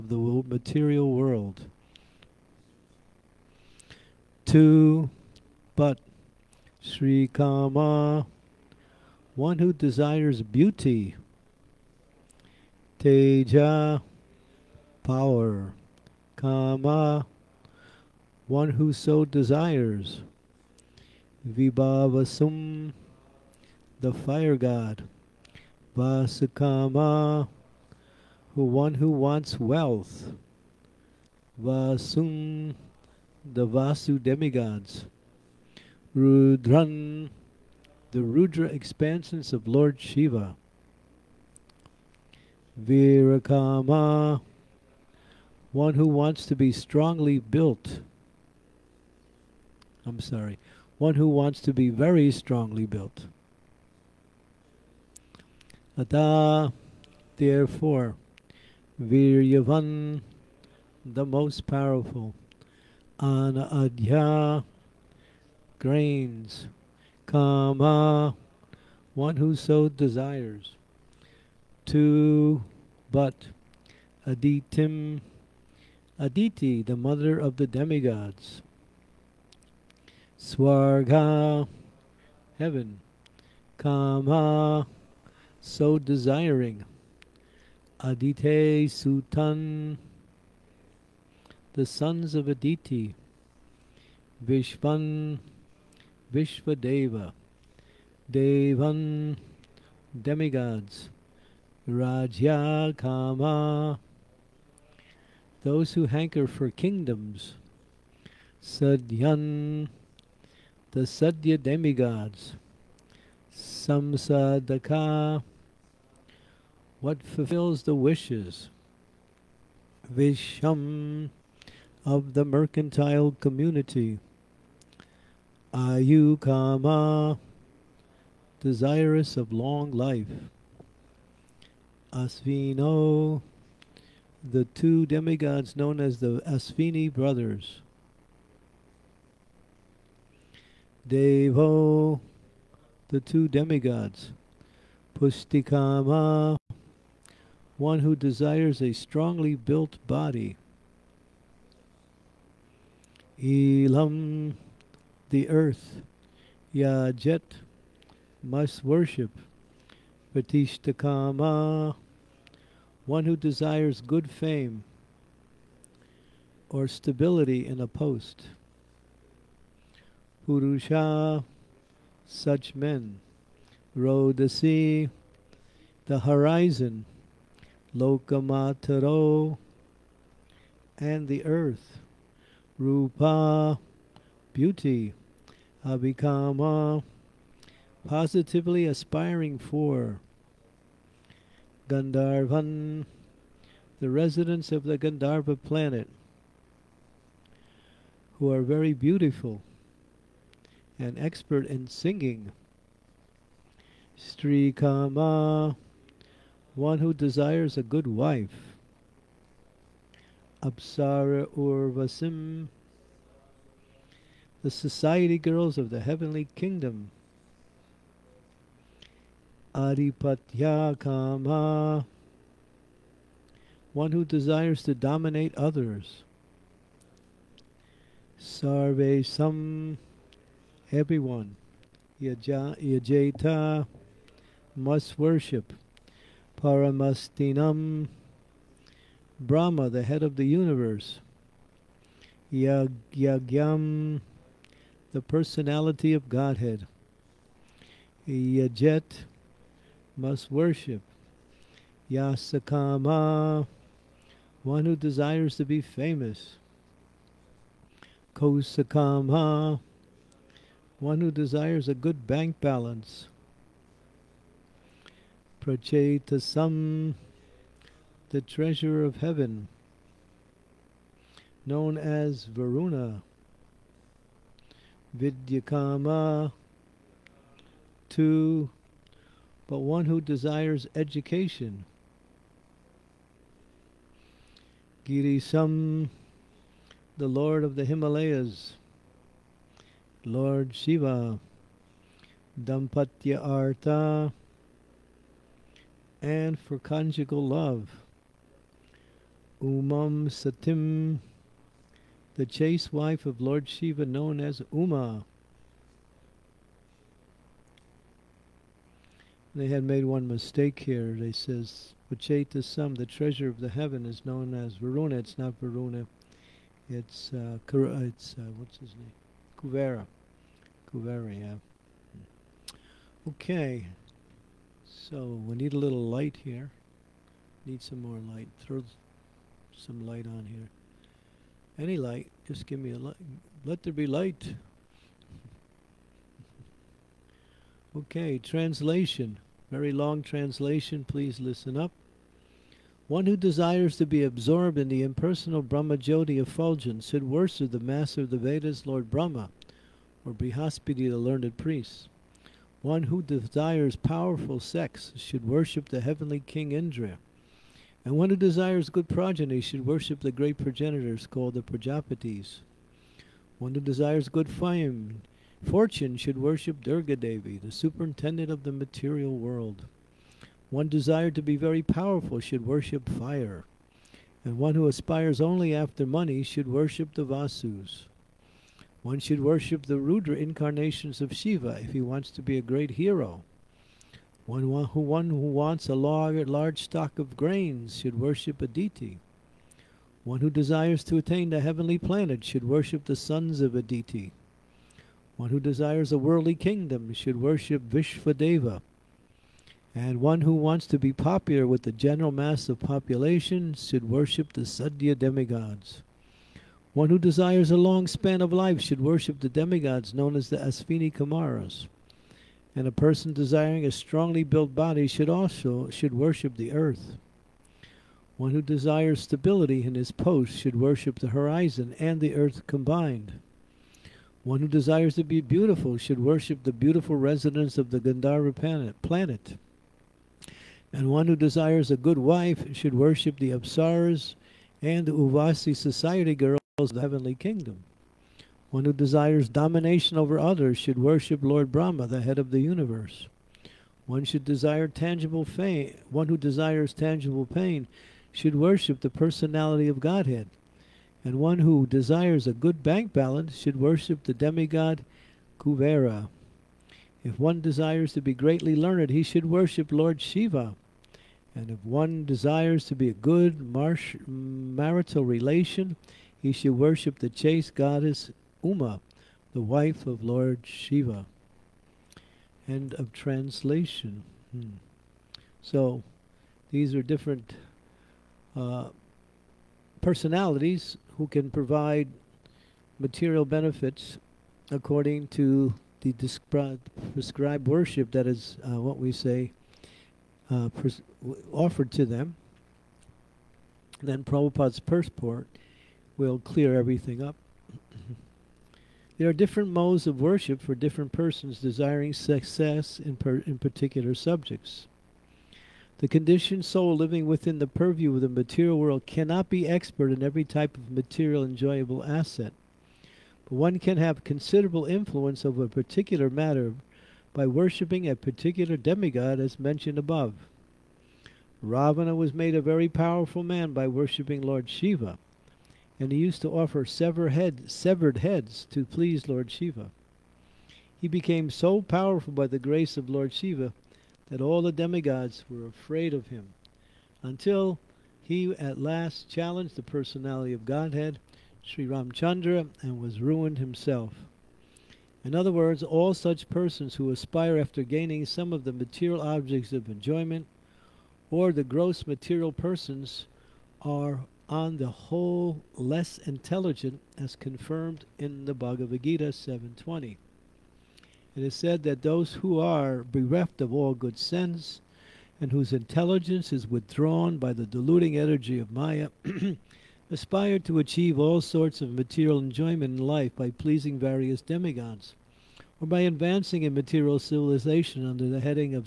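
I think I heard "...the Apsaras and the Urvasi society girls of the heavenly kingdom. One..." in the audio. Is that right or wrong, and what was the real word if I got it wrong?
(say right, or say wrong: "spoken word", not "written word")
right.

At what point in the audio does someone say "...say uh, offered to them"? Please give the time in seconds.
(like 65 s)
489 s.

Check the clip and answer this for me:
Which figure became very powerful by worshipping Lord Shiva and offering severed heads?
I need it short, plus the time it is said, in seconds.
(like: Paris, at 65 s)
Ravana, at 521 s.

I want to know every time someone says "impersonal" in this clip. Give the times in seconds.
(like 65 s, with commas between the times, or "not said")
345 s.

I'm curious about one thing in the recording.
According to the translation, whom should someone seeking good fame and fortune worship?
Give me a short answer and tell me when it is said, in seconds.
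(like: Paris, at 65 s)
Durga Devi, at 366 s.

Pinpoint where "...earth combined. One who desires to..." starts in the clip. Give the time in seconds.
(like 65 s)
422 s.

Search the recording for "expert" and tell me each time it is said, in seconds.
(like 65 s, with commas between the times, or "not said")
201 s, 509 s.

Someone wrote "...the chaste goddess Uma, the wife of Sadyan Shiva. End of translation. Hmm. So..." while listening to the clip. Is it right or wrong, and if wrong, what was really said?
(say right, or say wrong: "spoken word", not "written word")
wrong: "Lord", not "Sadyan".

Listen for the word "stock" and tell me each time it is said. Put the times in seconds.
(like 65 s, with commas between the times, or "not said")
386 s.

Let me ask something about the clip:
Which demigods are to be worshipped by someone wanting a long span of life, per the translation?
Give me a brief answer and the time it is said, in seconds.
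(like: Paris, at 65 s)
Asvini Kumaras, at 410 s.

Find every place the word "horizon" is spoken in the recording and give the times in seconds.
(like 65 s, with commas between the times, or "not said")
176 s, 421 s.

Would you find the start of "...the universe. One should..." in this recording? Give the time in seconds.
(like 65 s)
442 s.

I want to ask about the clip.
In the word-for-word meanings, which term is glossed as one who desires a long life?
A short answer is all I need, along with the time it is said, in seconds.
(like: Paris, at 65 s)
Ayukama, at 125 s.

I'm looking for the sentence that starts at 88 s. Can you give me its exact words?
Adite Sutan, the sons of Aditi.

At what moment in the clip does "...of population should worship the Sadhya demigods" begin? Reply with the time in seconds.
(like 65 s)
402 s.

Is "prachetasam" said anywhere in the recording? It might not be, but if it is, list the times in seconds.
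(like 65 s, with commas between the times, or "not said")
265 s, 312 s.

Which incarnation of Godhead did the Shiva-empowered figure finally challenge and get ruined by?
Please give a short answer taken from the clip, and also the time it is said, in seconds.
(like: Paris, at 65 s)
Sri Ramchandra, at 541 s.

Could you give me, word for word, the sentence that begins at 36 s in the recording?
Rudran, the Rudra expansions of Lord Shiva.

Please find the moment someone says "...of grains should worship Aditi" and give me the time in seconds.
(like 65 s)
387 s.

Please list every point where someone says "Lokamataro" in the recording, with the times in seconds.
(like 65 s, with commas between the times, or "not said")
177 s.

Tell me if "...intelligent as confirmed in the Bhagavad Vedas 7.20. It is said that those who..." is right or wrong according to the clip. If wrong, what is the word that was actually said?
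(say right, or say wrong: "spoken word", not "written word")
wrong: "Gita", not "Vedas".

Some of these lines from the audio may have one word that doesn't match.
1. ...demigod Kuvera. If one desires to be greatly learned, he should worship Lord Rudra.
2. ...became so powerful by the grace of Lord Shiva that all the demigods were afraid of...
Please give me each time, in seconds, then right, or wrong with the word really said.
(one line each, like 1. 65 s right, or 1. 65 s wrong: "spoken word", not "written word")
1. 454 s wrong: "Shiva", not "Rudra"
2. 531 s right.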